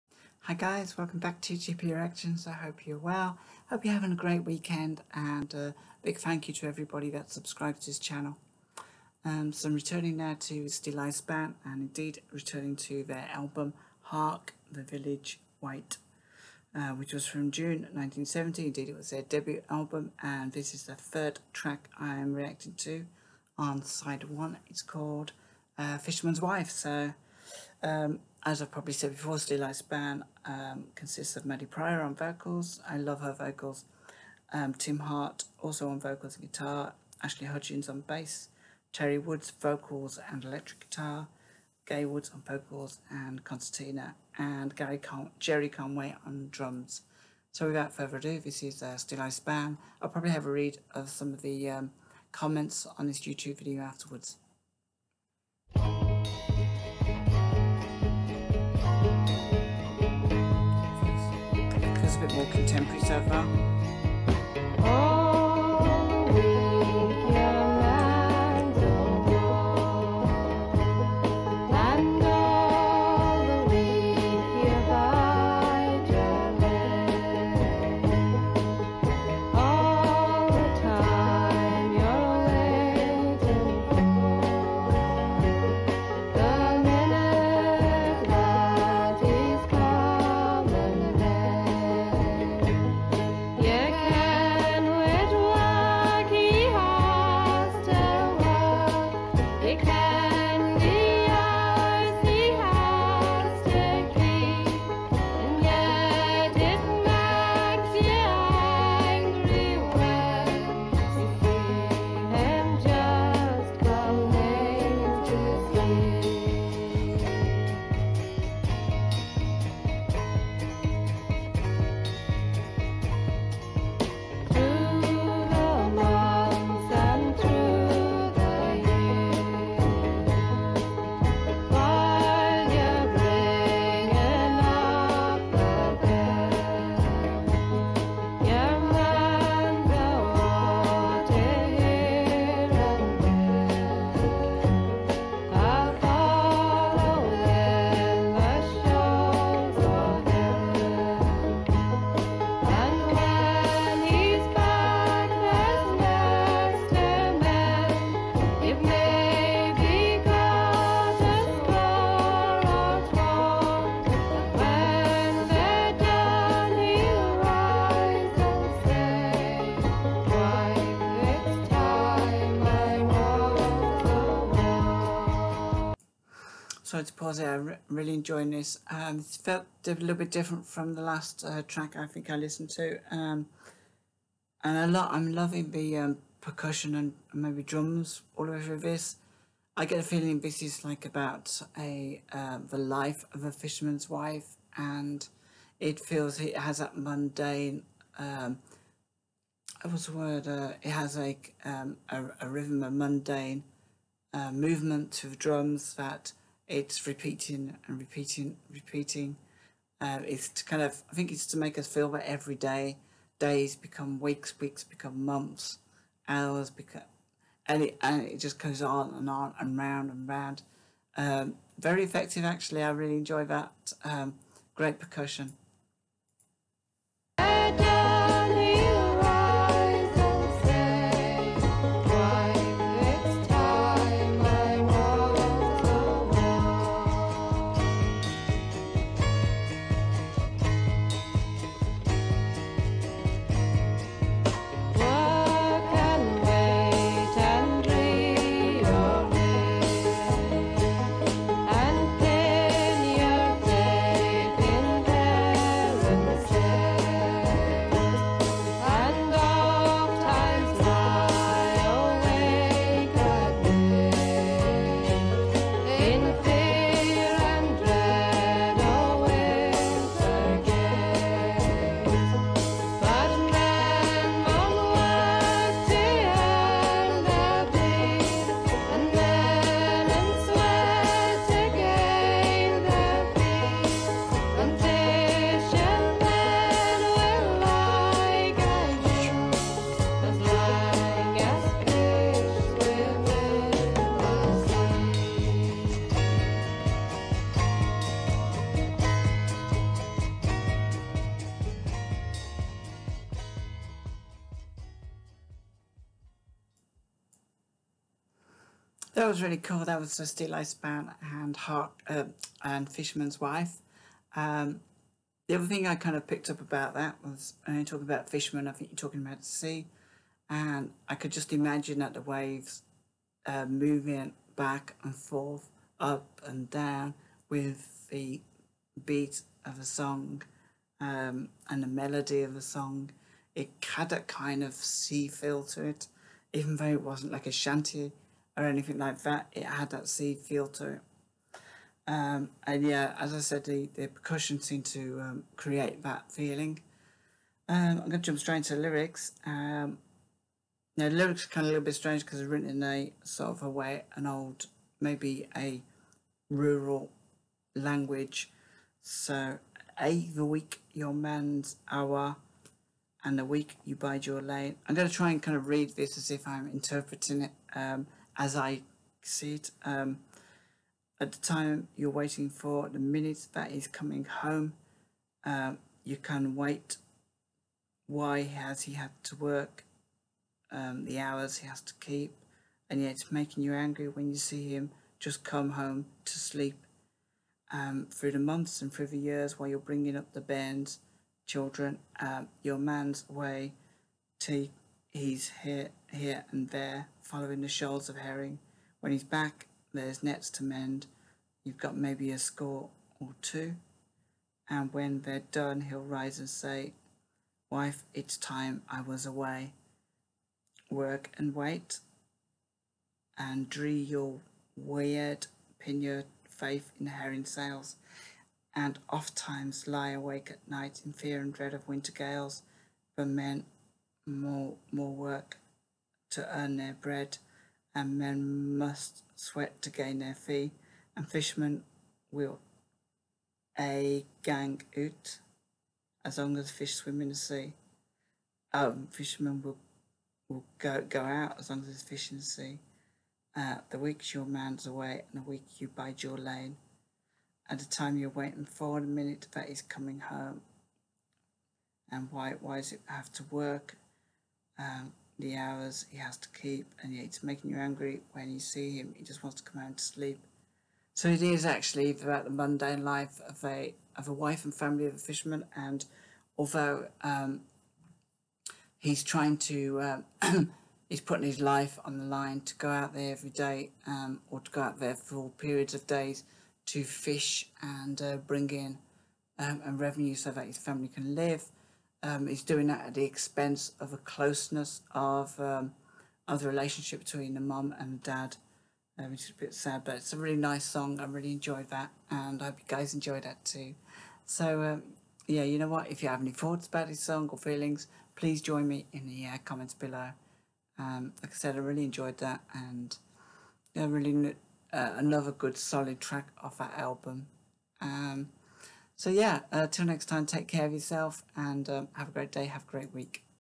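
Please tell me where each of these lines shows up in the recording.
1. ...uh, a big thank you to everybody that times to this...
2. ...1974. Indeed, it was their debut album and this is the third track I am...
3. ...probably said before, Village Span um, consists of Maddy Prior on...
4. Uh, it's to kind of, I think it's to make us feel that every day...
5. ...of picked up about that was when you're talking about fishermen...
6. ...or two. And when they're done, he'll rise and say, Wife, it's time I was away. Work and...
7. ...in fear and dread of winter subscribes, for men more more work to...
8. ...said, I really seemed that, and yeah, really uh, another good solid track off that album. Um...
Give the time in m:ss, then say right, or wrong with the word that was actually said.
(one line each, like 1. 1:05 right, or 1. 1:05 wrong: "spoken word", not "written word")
1. 0:05 wrong: "subscribes", not "times"
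2. 0:17 wrong: "1970", not "1974"
3. 0:28 wrong: "Steeleye", not "Village"
4. 3:29 right
5. 5:16 right
6. 6:43 right
7. 7:01 wrong: "gales", not "subscribes"
8. 8:21 wrong: "enjoyed", not "seemed".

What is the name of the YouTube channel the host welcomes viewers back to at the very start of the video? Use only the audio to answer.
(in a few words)
GP Reactions.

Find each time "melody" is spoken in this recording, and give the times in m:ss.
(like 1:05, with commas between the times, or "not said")
5:31.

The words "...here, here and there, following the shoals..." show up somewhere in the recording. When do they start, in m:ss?
6:35.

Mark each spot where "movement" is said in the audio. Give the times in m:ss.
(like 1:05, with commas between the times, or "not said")
3:24.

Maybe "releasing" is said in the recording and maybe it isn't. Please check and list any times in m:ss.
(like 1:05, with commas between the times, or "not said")
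not said.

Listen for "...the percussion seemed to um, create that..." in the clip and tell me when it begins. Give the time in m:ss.
5:43.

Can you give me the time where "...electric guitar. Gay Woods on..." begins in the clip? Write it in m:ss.
0:40.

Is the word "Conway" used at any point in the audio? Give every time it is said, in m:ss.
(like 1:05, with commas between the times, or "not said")
0:45.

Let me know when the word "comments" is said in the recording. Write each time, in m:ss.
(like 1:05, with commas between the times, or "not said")
0:52, 8:19.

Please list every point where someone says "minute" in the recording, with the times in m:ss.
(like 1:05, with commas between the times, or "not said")
6:12, 7:29.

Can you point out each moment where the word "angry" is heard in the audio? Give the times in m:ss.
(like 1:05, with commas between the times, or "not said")
6:23, 7:37.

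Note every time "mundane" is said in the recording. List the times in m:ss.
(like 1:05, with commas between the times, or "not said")
3:16, 3:22, 7:42.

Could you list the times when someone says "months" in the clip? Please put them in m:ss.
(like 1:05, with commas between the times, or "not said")
3:35, 6:28.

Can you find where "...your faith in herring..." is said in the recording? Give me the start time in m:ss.
6:55.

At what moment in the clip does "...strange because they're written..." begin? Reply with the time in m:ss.
5:51.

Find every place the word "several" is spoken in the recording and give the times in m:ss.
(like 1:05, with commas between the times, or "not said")
not said.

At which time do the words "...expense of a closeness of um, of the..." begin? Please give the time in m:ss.
8:03.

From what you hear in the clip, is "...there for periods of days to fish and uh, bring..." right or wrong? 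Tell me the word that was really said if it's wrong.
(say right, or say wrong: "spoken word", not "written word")
right.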